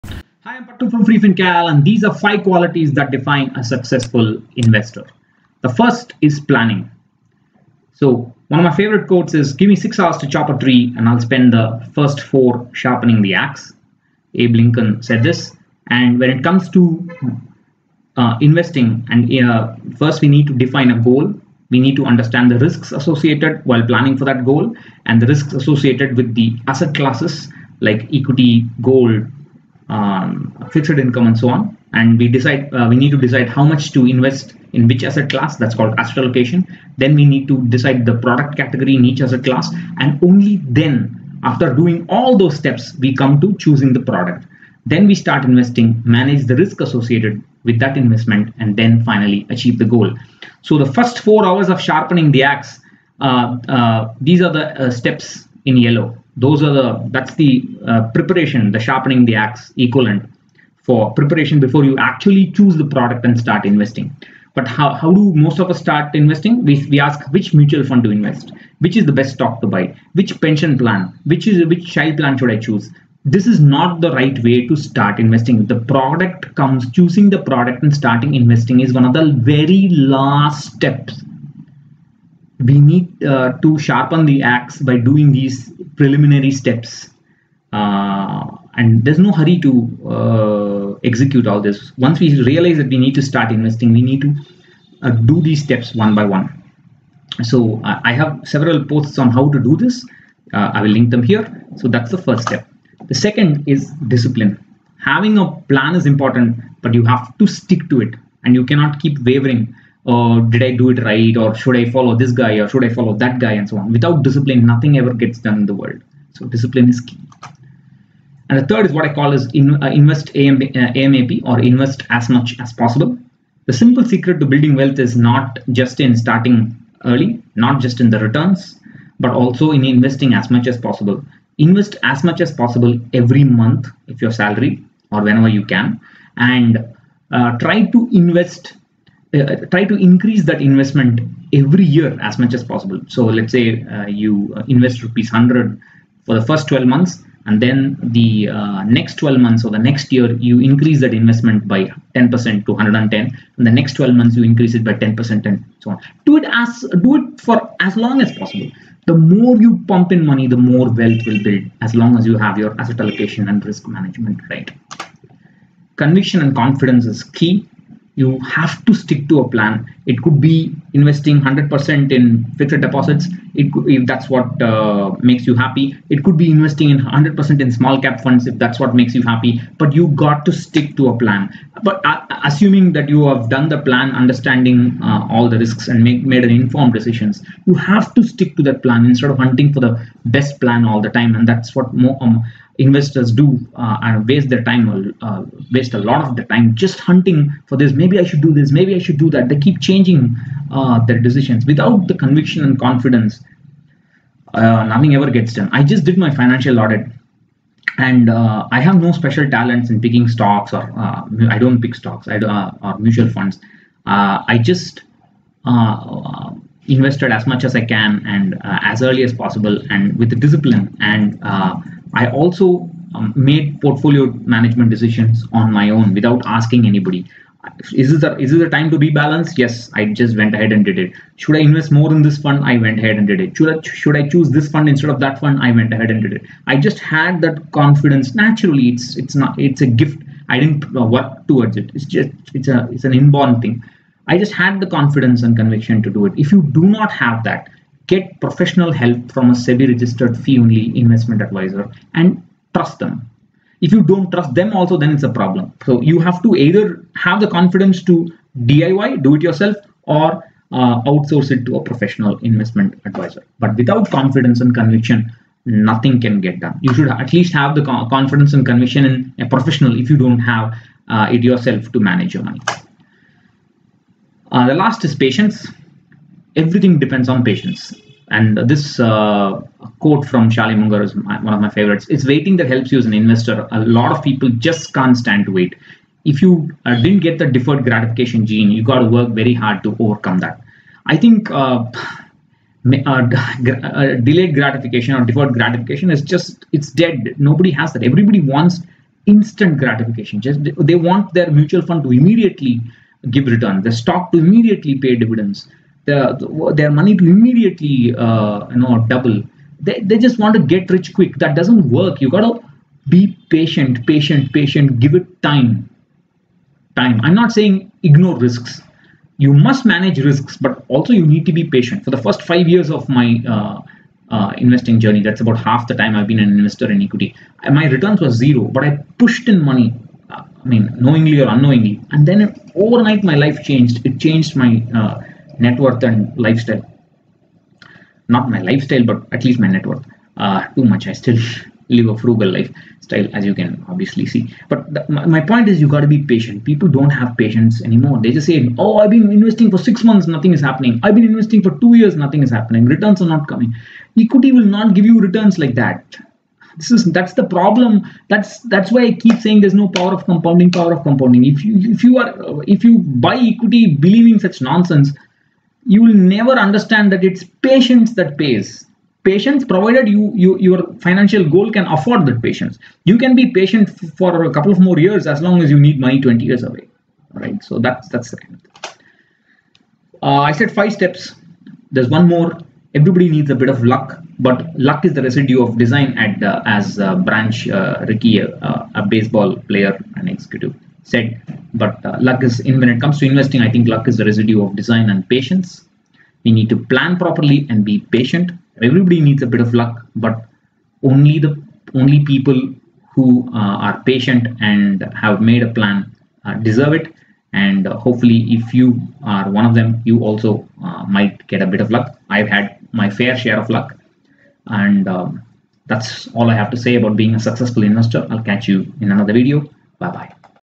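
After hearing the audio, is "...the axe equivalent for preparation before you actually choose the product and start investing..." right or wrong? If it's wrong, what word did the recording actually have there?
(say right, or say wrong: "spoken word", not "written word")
right.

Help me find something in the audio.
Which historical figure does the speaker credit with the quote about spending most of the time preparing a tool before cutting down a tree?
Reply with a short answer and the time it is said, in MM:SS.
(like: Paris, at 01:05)
Abe Lincoln, at 00:14.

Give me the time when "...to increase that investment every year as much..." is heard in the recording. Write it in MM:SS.
02:19.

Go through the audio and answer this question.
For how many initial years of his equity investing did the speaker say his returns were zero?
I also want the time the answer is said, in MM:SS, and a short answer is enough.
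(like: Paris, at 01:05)
5, at 05:22.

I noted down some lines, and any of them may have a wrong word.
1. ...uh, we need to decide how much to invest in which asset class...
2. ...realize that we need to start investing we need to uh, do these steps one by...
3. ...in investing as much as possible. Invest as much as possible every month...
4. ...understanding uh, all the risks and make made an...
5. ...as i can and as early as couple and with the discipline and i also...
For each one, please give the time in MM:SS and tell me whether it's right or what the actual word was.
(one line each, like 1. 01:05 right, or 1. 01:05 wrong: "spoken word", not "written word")
1. 00:32 right
2. 01:32 right
3. 02:09 right
4. 03:04 right
5. 03:37 wrong: "possible", not "couple".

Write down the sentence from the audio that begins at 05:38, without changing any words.
Not my lifestyle, but at least my net worth.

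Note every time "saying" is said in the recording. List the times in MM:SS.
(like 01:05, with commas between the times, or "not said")
05:17, 05:59.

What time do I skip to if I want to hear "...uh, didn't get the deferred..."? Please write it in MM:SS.
04:46.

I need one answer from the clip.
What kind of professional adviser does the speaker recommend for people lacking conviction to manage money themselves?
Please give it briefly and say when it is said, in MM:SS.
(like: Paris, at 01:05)
SEBI registered fee only investment advisor, at 04:09.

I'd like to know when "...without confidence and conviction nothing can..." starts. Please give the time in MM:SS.
04:23.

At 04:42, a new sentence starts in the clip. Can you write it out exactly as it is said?
It's waiting that helps you as an investor.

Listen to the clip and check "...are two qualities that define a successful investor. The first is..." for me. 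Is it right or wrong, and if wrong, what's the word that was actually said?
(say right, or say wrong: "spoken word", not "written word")
wrong: "five", not "two".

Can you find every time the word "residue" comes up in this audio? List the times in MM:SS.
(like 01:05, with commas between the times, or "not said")
06:25, 06:34.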